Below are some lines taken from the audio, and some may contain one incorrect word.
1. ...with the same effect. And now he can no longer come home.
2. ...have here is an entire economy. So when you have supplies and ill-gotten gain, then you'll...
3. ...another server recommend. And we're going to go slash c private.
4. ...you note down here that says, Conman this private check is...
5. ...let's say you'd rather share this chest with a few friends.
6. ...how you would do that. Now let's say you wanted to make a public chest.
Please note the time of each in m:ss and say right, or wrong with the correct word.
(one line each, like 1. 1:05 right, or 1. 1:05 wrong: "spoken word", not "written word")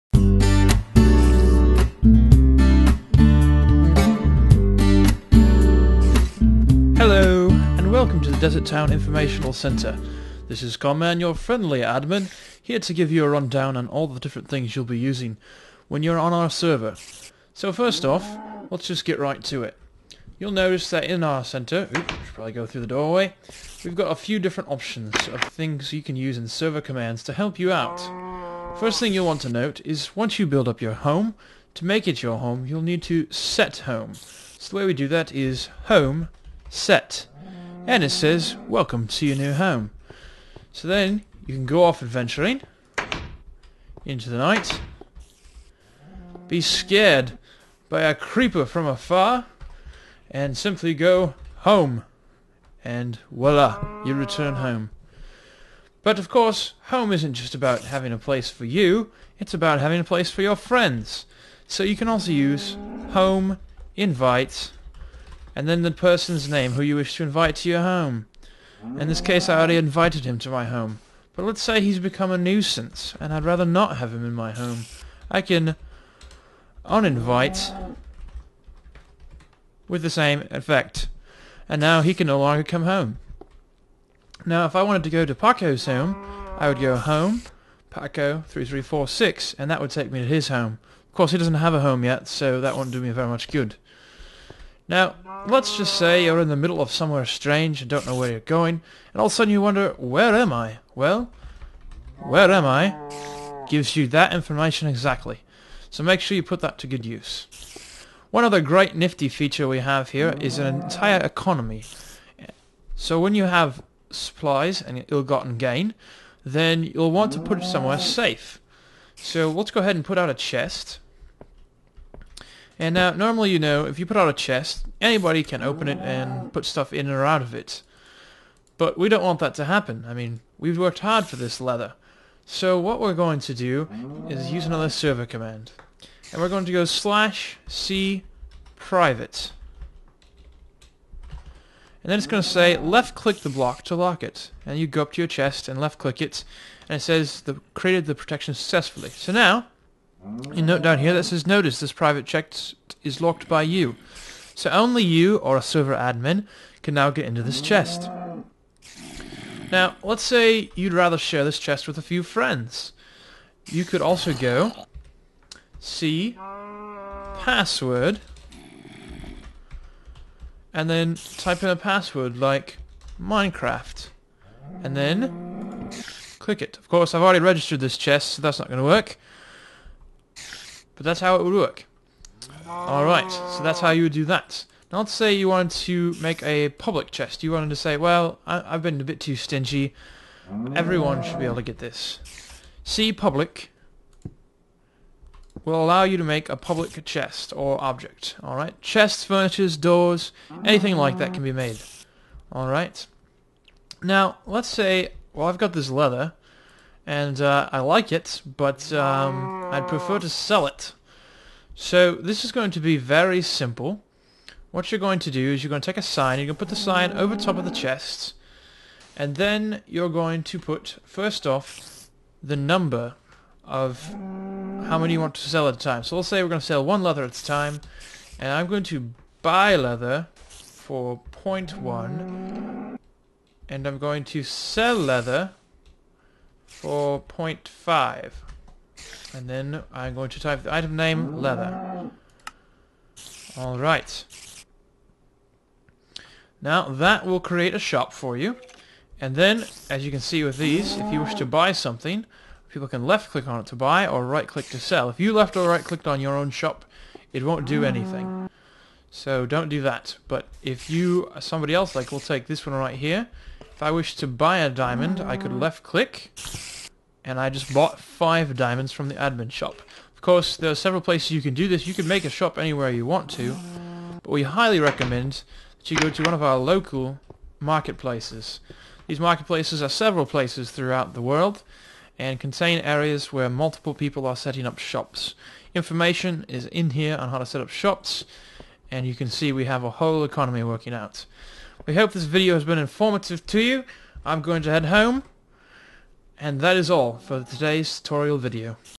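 1. 1:19 right
2. 1:49 right
3. 2:14 wrong: "command", not "recommend"
4. 2:30 wrong: "Notice", not "Conman"
5. 2:40 right
6. 3:03 right.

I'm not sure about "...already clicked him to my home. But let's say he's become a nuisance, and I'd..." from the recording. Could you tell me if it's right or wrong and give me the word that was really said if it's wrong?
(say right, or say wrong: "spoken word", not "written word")
wrong: "invited", not "clicked".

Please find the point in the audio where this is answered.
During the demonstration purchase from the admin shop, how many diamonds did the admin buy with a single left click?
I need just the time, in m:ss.
4:27.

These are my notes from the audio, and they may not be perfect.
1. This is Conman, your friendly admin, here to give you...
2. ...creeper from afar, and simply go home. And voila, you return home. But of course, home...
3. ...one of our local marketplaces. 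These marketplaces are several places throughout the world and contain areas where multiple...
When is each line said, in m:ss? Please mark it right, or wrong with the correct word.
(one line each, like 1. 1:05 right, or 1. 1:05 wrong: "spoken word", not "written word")
1. 0:10 right
2. 0:48 right
3. 4:36 right.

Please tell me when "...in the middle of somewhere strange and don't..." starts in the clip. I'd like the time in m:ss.
1:36.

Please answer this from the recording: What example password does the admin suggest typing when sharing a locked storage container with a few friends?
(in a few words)
Minecraft.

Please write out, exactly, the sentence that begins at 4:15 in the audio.
If you left or right clicked on your own shop, it won't do anything.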